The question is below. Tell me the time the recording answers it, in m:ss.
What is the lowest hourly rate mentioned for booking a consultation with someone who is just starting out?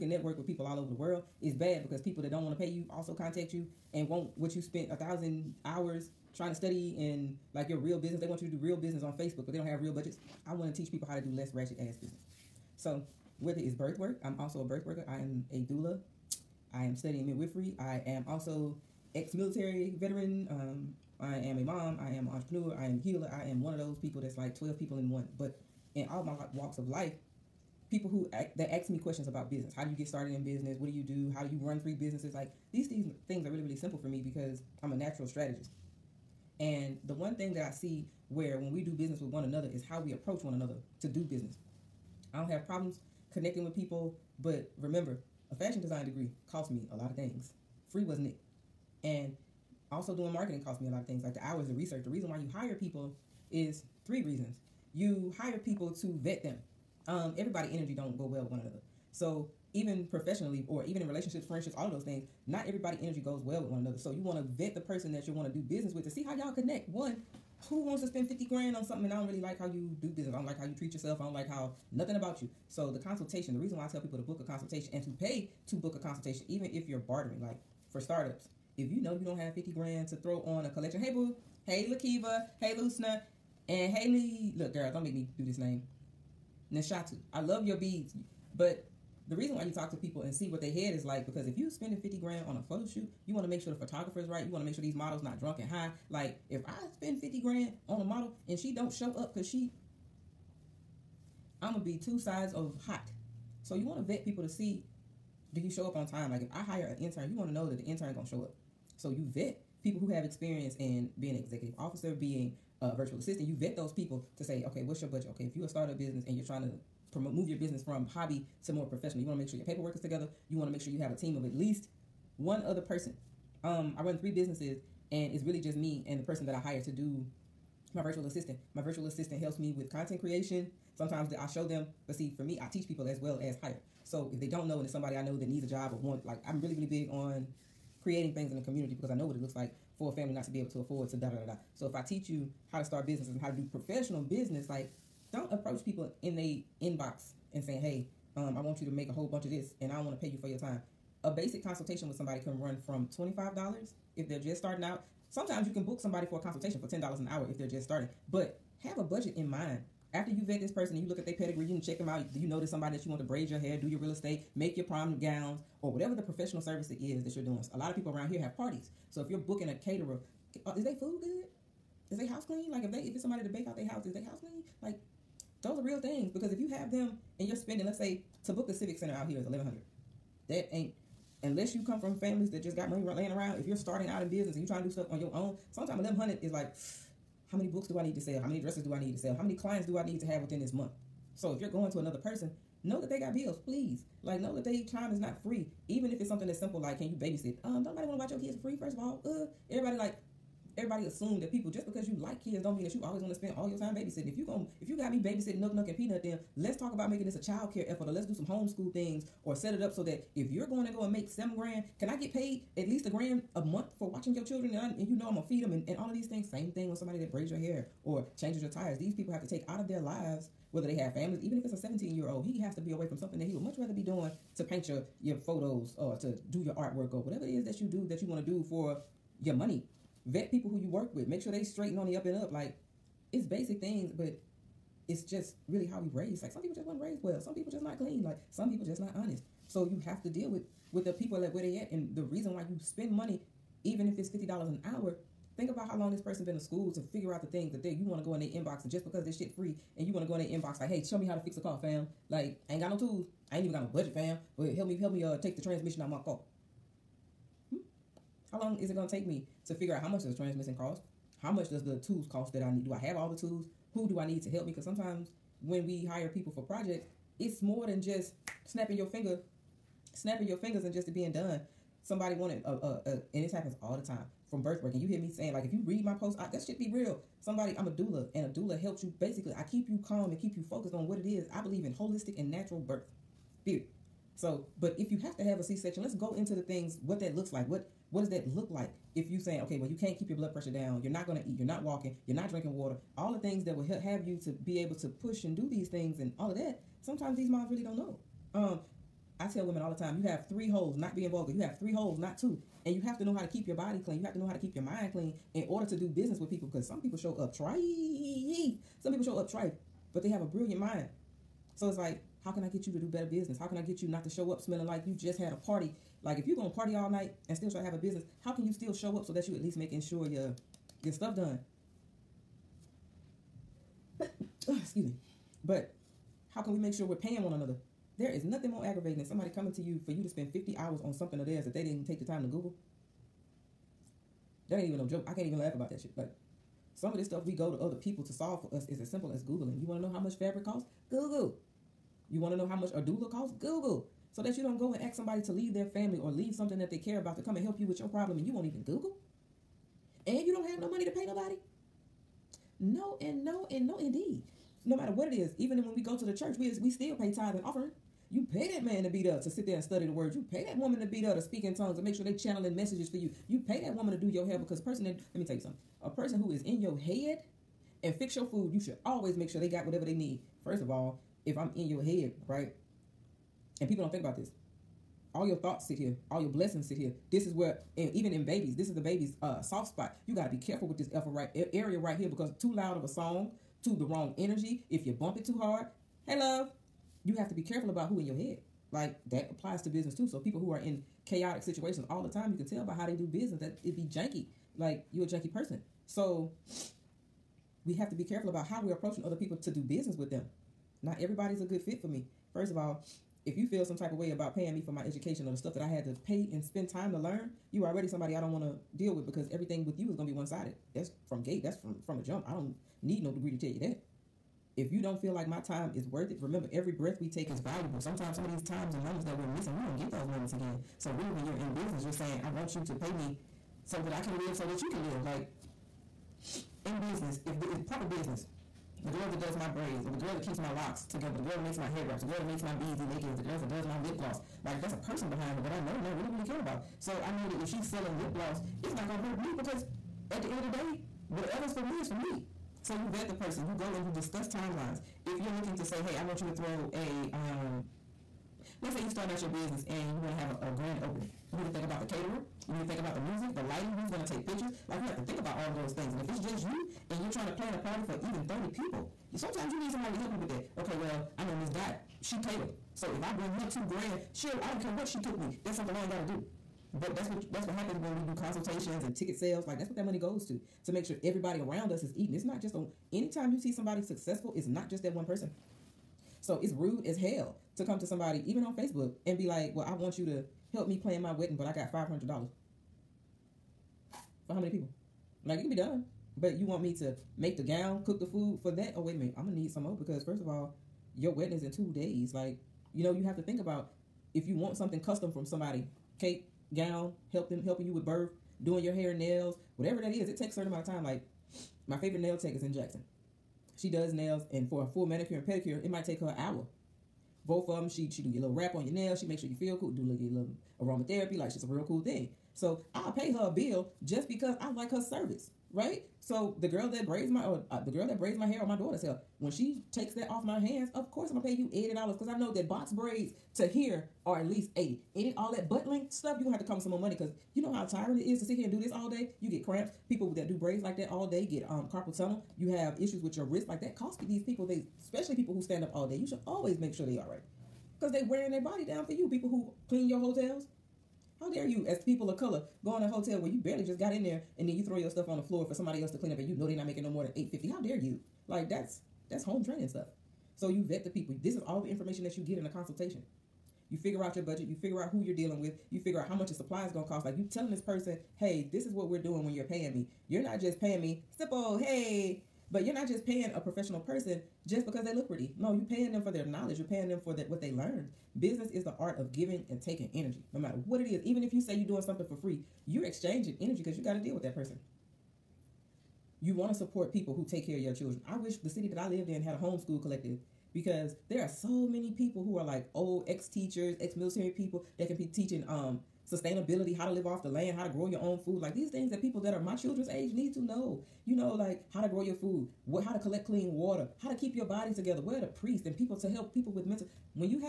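2:36.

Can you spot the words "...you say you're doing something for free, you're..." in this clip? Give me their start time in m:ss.
9:31.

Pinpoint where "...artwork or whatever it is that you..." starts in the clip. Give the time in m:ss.
3:46.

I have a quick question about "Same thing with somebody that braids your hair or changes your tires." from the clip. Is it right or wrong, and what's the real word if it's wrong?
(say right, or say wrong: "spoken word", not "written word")
right.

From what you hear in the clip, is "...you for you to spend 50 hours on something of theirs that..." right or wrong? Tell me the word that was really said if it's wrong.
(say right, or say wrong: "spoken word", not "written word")
right.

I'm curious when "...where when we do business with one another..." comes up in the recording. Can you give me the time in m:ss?
0:38.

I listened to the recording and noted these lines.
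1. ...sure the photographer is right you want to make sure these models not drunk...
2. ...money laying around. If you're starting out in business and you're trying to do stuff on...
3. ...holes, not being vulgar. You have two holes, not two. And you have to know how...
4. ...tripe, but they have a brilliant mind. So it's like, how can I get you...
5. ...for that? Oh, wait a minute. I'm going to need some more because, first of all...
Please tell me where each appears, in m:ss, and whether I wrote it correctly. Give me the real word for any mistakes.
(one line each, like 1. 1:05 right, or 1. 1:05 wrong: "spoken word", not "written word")
1. 1:33 right
2. 3:02 right
3. 5:00 wrong: "three", not "two"
4. 5:09 right
5. 8:08 right.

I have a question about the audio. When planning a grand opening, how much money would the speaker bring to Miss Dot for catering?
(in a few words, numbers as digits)
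$2,000.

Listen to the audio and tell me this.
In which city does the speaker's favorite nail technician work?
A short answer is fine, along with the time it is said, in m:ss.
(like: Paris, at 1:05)
Jackson, at 8:22.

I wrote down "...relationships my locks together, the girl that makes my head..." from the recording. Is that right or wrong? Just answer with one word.
wrong.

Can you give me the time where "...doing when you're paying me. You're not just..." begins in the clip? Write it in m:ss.
9:19.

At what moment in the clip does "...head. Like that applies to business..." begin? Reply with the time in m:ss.
6:28.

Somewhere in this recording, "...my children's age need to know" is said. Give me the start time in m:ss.
9:49.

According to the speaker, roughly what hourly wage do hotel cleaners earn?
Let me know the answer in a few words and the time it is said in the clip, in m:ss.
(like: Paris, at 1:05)
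$8.50, at 9:07.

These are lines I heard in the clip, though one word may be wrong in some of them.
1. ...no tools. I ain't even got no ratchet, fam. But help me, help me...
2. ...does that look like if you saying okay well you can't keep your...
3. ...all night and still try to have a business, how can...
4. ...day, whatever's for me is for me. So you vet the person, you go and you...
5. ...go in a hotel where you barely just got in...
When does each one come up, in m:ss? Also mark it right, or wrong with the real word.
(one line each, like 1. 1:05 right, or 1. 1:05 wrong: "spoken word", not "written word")
1. 4:12 wrong: "budget", not "ratchet"
2. 4:48 right
3. 5:16 right
4. 7:20 right
5. 9:02 right.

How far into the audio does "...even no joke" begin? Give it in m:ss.
5:34.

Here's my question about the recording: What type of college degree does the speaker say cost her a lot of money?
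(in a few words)
fashion design.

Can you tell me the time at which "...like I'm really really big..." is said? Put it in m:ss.
2:16.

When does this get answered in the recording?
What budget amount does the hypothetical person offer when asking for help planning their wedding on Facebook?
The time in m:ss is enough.
8:01.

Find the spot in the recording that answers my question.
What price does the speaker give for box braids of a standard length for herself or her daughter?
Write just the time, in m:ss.
8:41.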